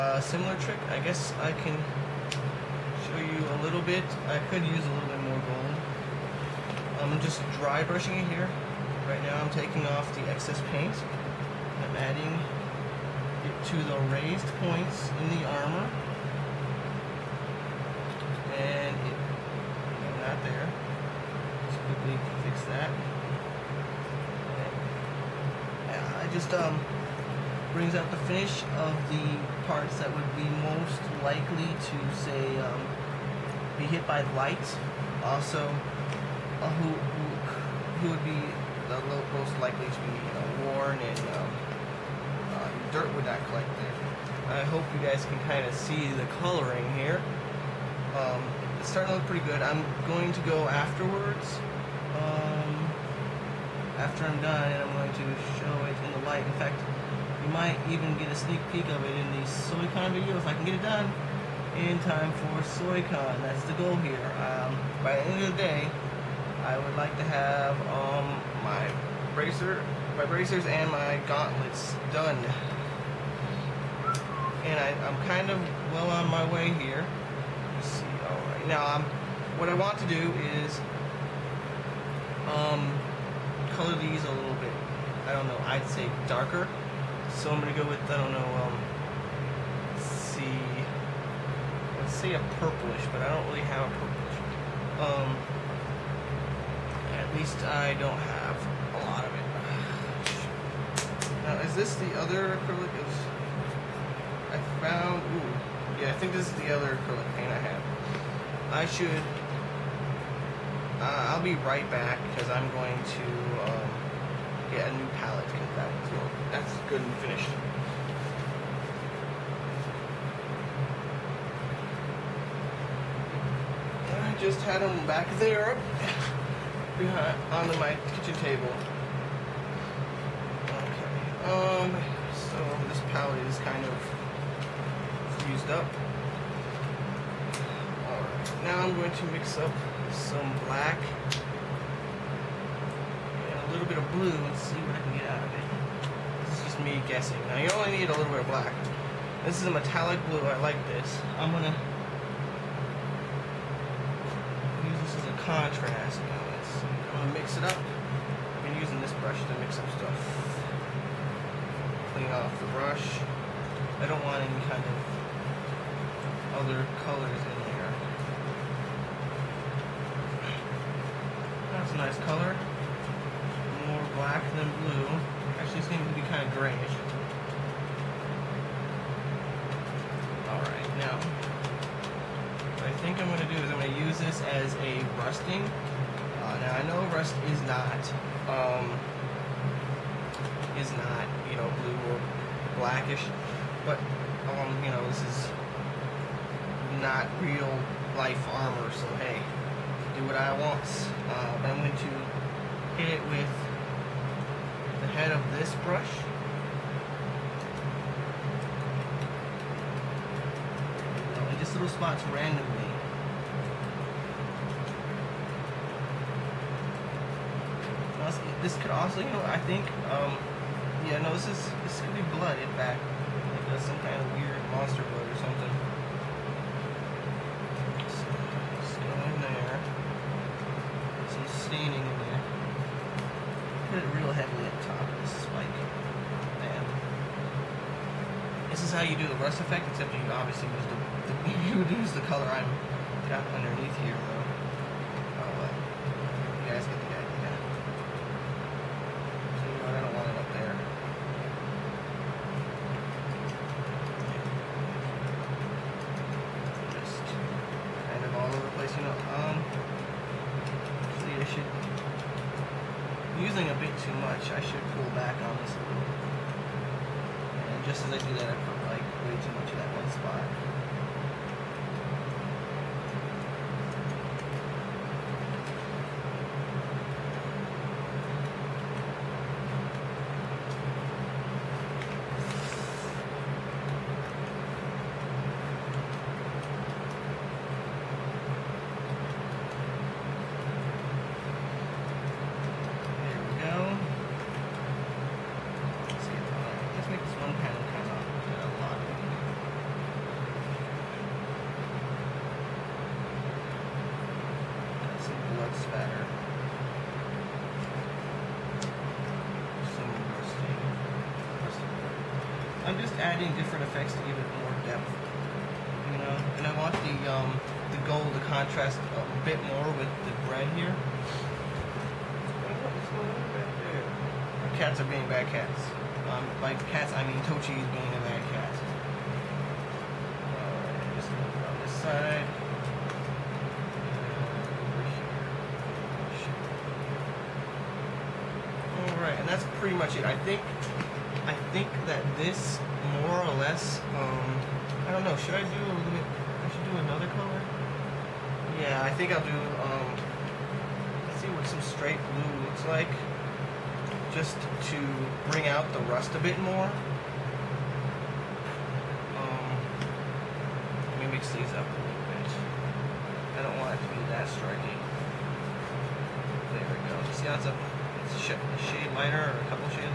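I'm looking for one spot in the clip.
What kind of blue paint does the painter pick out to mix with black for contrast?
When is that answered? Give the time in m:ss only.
2:29.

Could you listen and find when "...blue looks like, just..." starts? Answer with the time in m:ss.
5:52.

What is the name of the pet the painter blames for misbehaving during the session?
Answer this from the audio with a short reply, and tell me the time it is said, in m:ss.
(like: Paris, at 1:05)
Tochi, at 5:27.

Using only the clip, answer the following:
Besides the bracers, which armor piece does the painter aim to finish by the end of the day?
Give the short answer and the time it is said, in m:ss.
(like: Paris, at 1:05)
Gauntlets, at 1:11.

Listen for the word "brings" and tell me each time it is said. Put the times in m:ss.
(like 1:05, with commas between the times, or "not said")
0:27, 5:55.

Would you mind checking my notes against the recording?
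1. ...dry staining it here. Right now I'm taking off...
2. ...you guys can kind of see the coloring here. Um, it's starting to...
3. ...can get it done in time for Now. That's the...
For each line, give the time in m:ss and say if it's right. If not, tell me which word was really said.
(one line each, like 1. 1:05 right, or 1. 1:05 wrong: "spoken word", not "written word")
1. 0:07 wrong: "brushing", not "staining"
2. 0:44 right
3. 1:00 wrong: "SoyCon", not "Now".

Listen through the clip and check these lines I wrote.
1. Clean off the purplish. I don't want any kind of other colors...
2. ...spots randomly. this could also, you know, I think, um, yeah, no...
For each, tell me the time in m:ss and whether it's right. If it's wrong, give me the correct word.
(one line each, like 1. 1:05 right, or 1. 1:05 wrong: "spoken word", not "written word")
1. 2:42 wrong: "brush", not "purplish"
2. 3:31 right.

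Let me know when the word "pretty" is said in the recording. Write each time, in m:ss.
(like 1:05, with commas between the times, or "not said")
0:49, 5:39.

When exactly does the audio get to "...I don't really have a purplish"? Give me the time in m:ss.
1:33.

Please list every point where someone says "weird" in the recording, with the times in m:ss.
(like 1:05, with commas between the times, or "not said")
3:44.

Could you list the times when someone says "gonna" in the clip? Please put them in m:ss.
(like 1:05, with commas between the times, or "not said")
1:27, 2:31, 2:37.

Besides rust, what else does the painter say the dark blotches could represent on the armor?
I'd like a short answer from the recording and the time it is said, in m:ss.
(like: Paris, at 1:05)
Monster blood, at 3:44.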